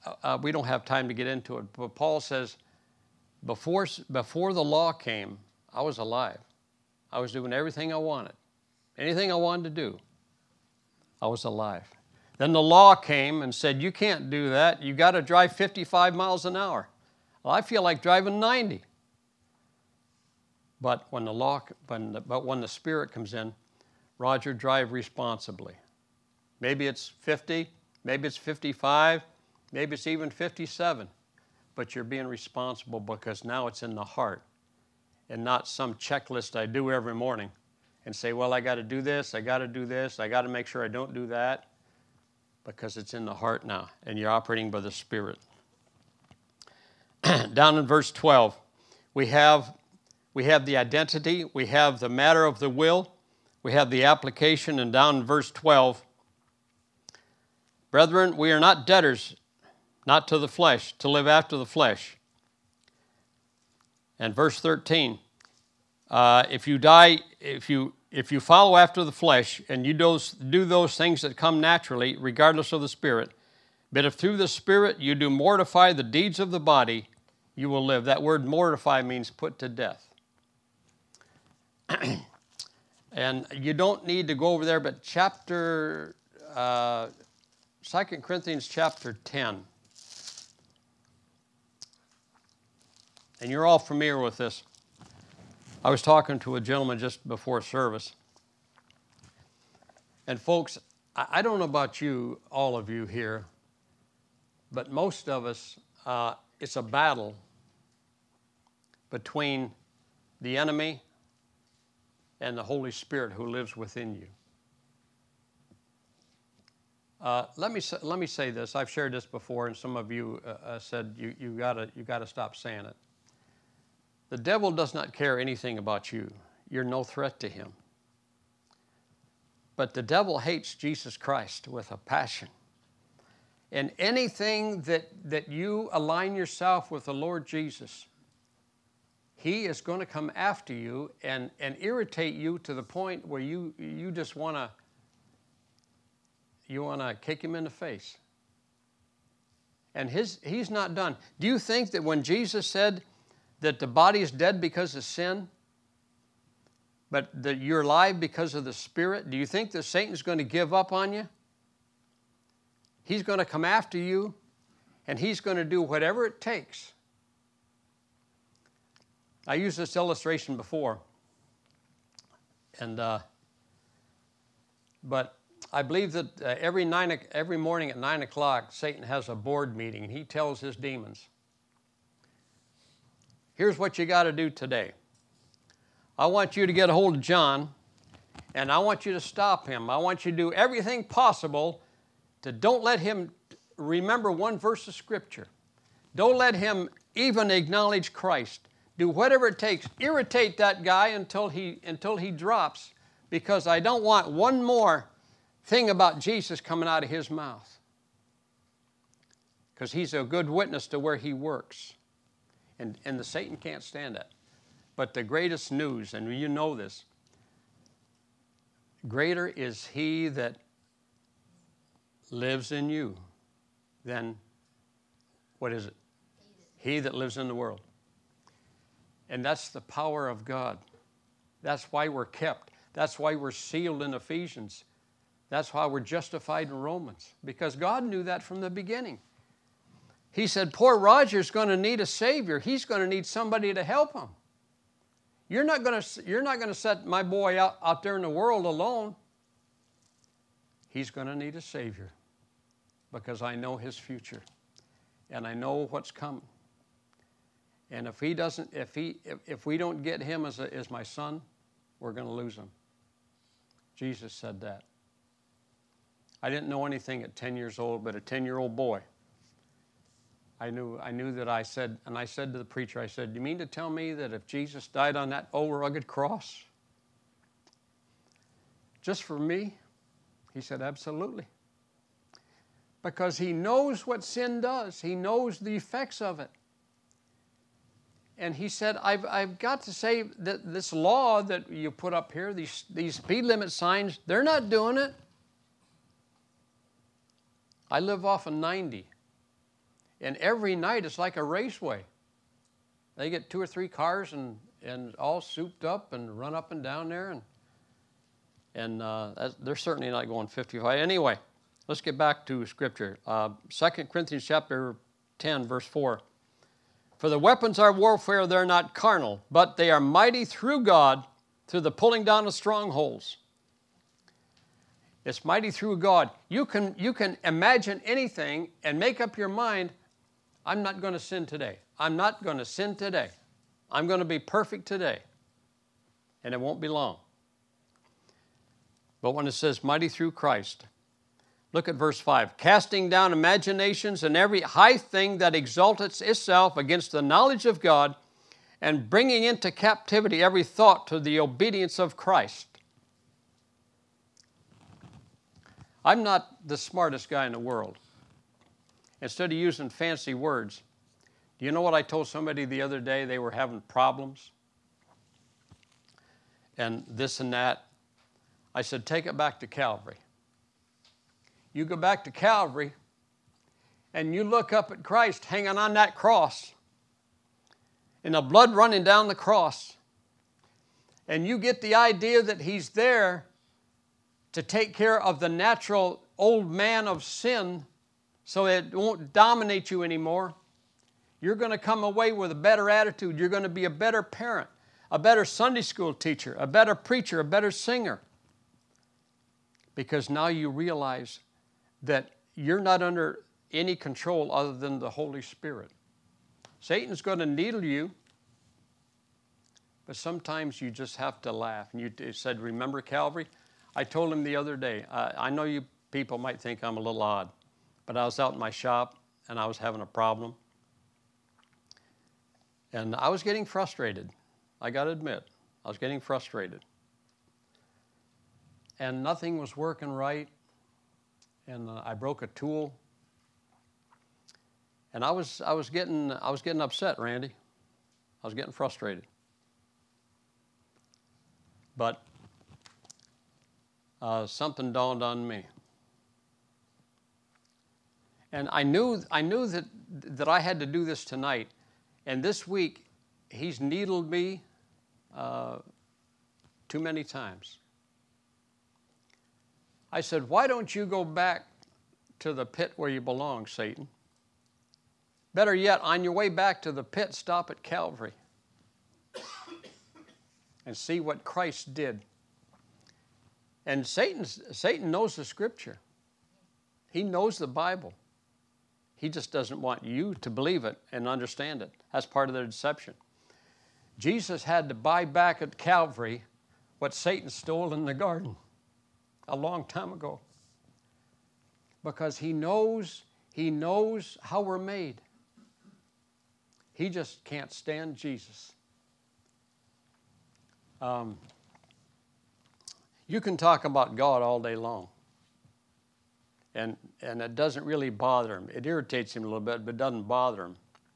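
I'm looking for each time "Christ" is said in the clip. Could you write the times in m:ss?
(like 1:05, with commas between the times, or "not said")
2:11, 3:18, 5:40, 5:52, 6:15, 7:51.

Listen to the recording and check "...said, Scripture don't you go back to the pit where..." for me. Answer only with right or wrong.
wrong.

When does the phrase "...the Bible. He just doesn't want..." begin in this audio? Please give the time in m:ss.
7:57.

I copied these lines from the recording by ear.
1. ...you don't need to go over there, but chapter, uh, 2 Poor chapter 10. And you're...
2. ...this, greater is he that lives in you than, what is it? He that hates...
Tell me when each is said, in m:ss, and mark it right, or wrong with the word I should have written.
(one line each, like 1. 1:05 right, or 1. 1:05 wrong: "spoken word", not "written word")
1. 1:23 wrong: "Corinthians", not "Poor"
2. 3:36 wrong: "lives", not "hates".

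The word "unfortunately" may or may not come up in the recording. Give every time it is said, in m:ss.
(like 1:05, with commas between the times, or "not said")
not said.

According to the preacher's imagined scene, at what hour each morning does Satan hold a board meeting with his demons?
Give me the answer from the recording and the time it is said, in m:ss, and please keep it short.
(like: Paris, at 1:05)
9 o'clock, at 2:57.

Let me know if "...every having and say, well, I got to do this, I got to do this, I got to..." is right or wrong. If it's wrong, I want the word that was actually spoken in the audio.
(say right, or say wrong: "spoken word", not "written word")
wrong: "morning", not "having".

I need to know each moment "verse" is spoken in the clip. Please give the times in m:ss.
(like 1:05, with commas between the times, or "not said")
0:47, 0:55, 1:04, 3:14, 5:15, 5:41.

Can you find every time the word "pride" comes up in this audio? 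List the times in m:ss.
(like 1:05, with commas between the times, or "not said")
not said.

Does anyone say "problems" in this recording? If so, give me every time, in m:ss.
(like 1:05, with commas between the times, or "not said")
6:03, 7:00.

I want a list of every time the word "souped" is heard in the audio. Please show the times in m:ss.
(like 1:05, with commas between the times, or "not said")
5:05.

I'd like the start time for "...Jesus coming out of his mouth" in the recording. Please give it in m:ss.
3:26.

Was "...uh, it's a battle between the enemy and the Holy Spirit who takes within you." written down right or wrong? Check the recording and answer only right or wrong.
wrong.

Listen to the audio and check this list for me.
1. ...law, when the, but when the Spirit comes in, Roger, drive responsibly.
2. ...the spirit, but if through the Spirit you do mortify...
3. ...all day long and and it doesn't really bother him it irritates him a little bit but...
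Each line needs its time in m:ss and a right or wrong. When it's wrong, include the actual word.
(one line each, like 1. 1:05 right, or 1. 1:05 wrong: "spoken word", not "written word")
1. 0:21 right
2. 1:12 right
3. 8:24 right.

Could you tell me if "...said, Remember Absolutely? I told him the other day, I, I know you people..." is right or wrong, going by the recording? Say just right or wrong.
wrong.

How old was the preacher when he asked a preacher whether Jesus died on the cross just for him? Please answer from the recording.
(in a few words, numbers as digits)
10.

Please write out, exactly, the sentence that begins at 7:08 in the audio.
And nothing was working right and uh, I broke a tool.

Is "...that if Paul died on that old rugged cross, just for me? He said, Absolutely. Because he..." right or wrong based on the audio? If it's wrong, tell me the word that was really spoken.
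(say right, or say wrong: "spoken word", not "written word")
wrong: "Jesus", not "Paul".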